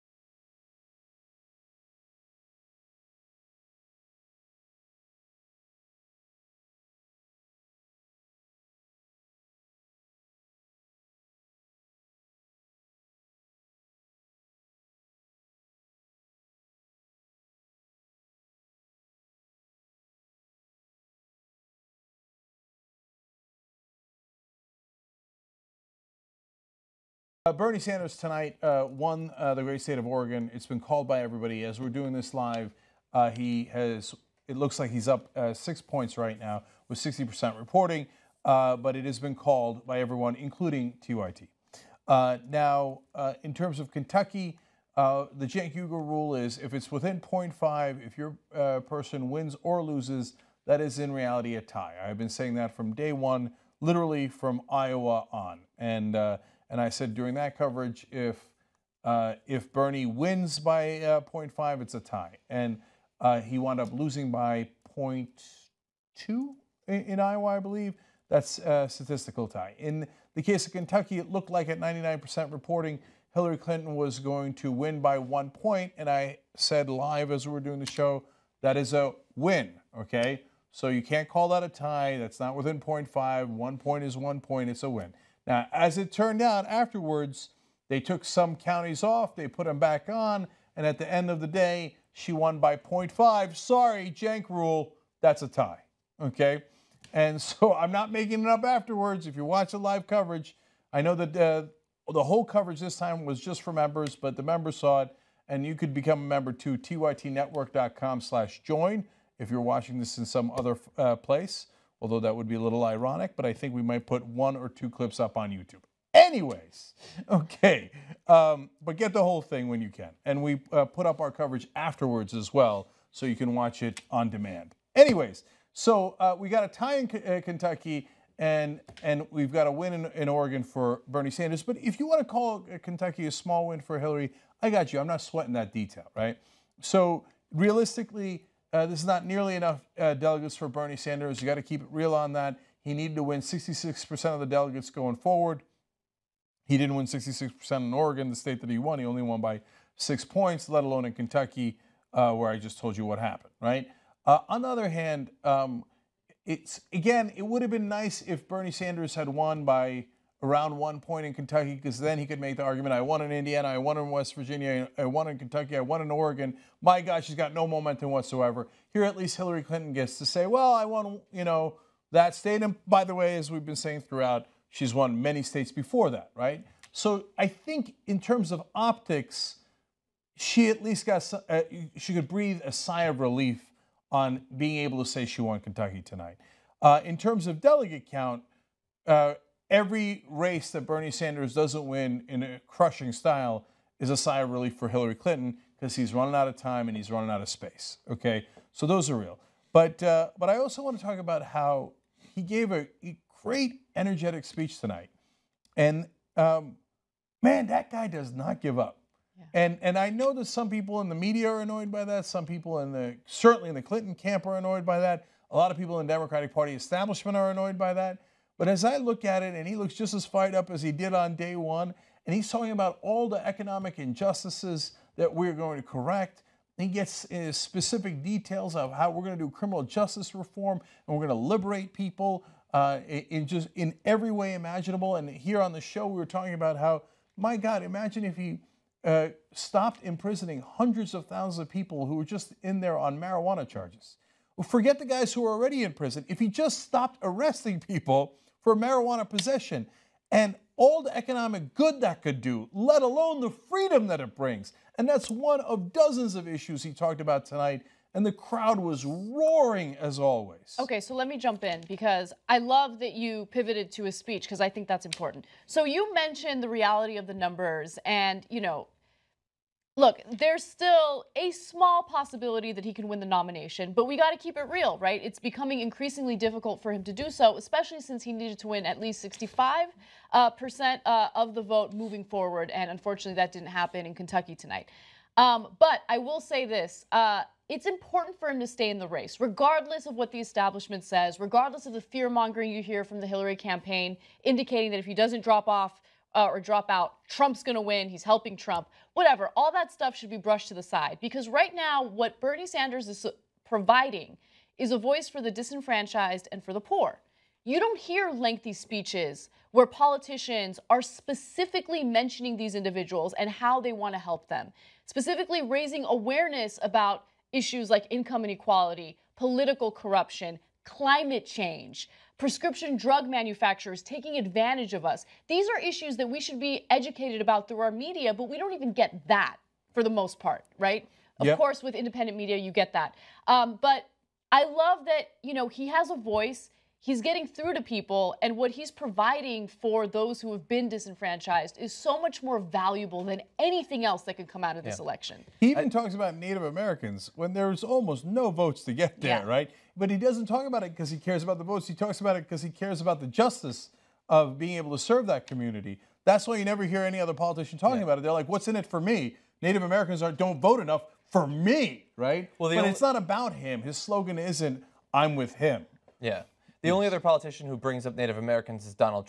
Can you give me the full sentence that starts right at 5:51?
He talks about it because he cares about the justice of being able to serve that community.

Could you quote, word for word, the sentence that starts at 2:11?
But if you want to call uh, Kentucky a small win for Hillary, I got you.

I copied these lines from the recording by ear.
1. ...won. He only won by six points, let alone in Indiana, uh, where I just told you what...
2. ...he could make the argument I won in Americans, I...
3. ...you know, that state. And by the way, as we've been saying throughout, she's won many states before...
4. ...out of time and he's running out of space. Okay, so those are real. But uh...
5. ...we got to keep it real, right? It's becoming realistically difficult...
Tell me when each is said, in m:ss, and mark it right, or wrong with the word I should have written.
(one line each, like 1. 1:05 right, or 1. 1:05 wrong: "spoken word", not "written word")
1. 2:28 wrong: "Kentucky", not "Indiana"
2. 2:42 wrong: "Indiana", not "Americans"
3. 2:51 right
4. 3:16 right
5. 4:34 wrong: "increasingly", not "realistically".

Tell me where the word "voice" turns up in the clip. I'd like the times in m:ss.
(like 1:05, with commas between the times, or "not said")
5:04, 5:36.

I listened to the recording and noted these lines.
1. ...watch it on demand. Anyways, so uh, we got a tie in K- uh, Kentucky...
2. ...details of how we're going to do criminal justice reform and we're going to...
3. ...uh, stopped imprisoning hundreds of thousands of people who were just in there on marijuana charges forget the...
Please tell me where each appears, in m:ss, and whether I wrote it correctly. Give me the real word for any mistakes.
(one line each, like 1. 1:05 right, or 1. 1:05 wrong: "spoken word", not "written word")
1. 2:03 right
2. 3:48 right
3. 3:59 right.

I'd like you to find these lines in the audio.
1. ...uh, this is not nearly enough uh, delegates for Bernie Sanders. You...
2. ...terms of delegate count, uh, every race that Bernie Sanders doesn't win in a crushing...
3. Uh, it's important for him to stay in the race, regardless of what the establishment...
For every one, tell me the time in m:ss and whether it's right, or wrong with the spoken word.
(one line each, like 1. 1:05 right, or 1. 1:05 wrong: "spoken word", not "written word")
1. 2:18 right
2. 3:07 right
3. 4:47 right.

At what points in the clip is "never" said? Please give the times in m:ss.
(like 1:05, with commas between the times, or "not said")
5:56.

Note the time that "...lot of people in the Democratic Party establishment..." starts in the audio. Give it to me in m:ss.
3:35.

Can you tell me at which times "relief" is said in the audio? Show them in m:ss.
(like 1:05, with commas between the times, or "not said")
3:03, 3:14.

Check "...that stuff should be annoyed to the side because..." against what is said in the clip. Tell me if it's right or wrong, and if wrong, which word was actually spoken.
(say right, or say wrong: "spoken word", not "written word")
wrong: "brushed", not "annoyed".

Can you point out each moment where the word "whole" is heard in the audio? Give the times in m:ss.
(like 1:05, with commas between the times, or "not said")
1:42, 1:59.